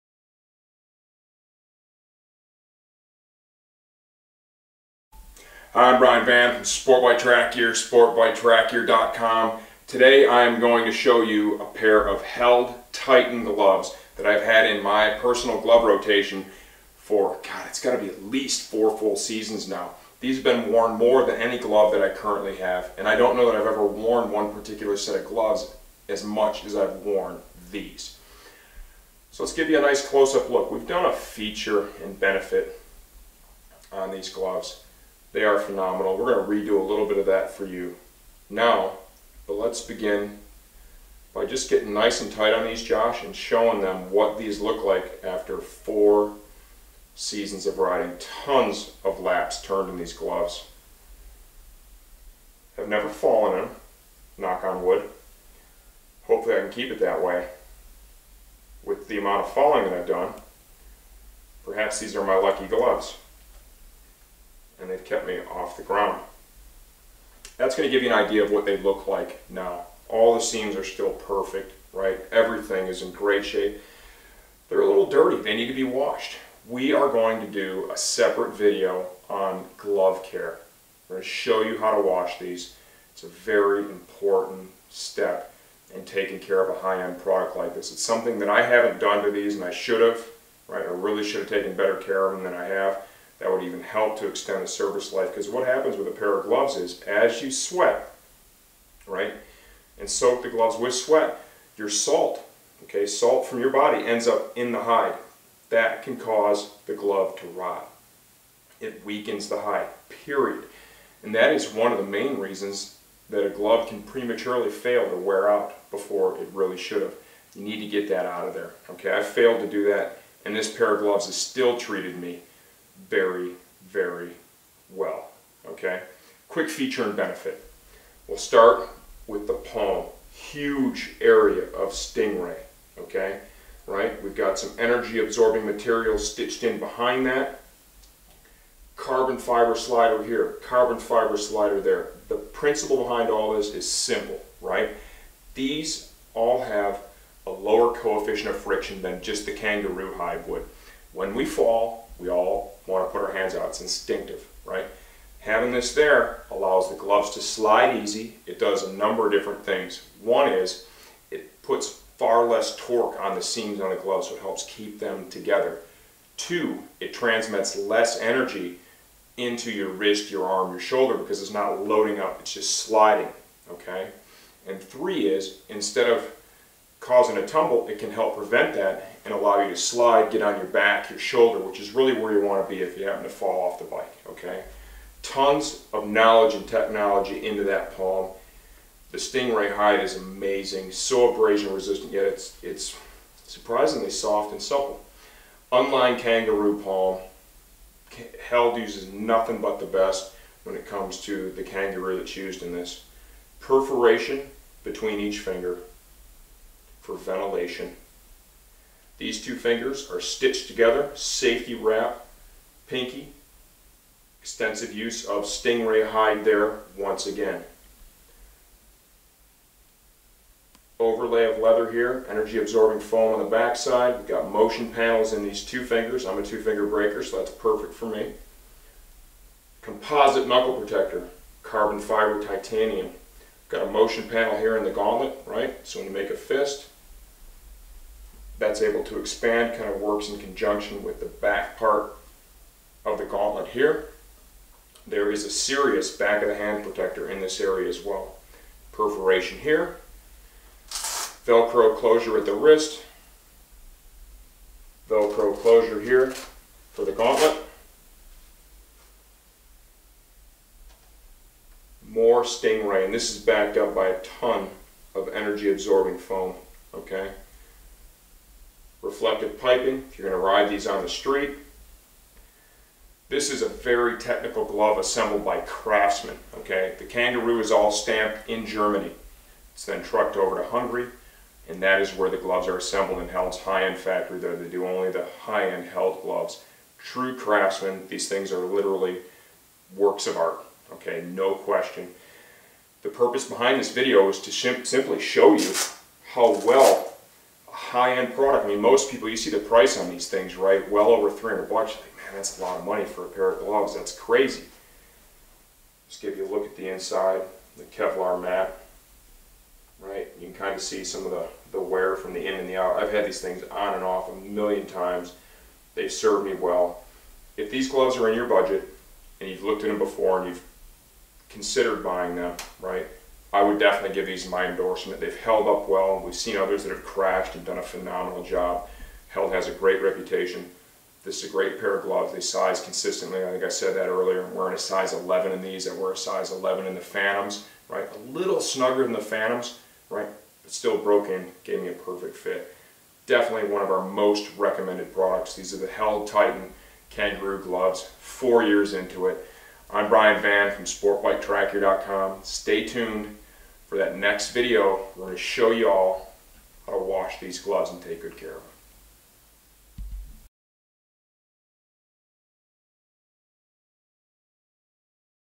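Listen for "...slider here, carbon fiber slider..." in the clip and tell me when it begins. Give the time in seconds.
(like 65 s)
139 s.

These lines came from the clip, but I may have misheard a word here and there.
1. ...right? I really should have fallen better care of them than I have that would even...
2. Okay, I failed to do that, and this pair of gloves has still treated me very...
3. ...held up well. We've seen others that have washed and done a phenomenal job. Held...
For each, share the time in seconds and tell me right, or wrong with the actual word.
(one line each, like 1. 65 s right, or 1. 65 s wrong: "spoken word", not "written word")
1. 90 s wrong: "taken", not "fallen"
2. 118 s right
3. 325 s wrong: "crashed", not "washed".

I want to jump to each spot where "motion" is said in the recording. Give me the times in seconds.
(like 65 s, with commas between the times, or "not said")
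224 s, 233 s.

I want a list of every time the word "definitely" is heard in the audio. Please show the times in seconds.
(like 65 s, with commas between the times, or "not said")
323 s, 343 s.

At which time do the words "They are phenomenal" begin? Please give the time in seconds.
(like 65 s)
35 s.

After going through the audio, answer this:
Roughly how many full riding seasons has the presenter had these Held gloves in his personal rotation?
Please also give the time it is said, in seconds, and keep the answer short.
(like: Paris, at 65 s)
4, at 18 s.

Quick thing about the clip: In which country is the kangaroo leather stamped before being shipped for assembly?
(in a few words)
Germany.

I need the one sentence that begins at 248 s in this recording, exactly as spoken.
Perforation here, Velcro closure at the wrist, Velcro closure here for the gauntlet.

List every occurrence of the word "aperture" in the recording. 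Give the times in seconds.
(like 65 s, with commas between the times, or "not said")
not said.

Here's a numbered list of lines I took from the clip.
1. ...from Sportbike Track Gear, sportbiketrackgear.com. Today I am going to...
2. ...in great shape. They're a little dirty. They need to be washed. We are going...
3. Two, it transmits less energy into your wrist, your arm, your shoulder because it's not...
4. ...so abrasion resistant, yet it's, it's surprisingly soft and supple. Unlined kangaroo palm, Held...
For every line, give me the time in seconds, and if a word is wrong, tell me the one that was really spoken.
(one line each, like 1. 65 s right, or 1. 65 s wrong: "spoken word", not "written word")
1. 6 s right
2. 73 s right
3. 166 s right
4. 190 s right.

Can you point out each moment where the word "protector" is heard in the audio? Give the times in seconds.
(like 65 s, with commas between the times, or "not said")
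230 s, 246 s.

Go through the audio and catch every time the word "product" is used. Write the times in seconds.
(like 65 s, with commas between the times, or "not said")
87 s, 298 s, 345 s.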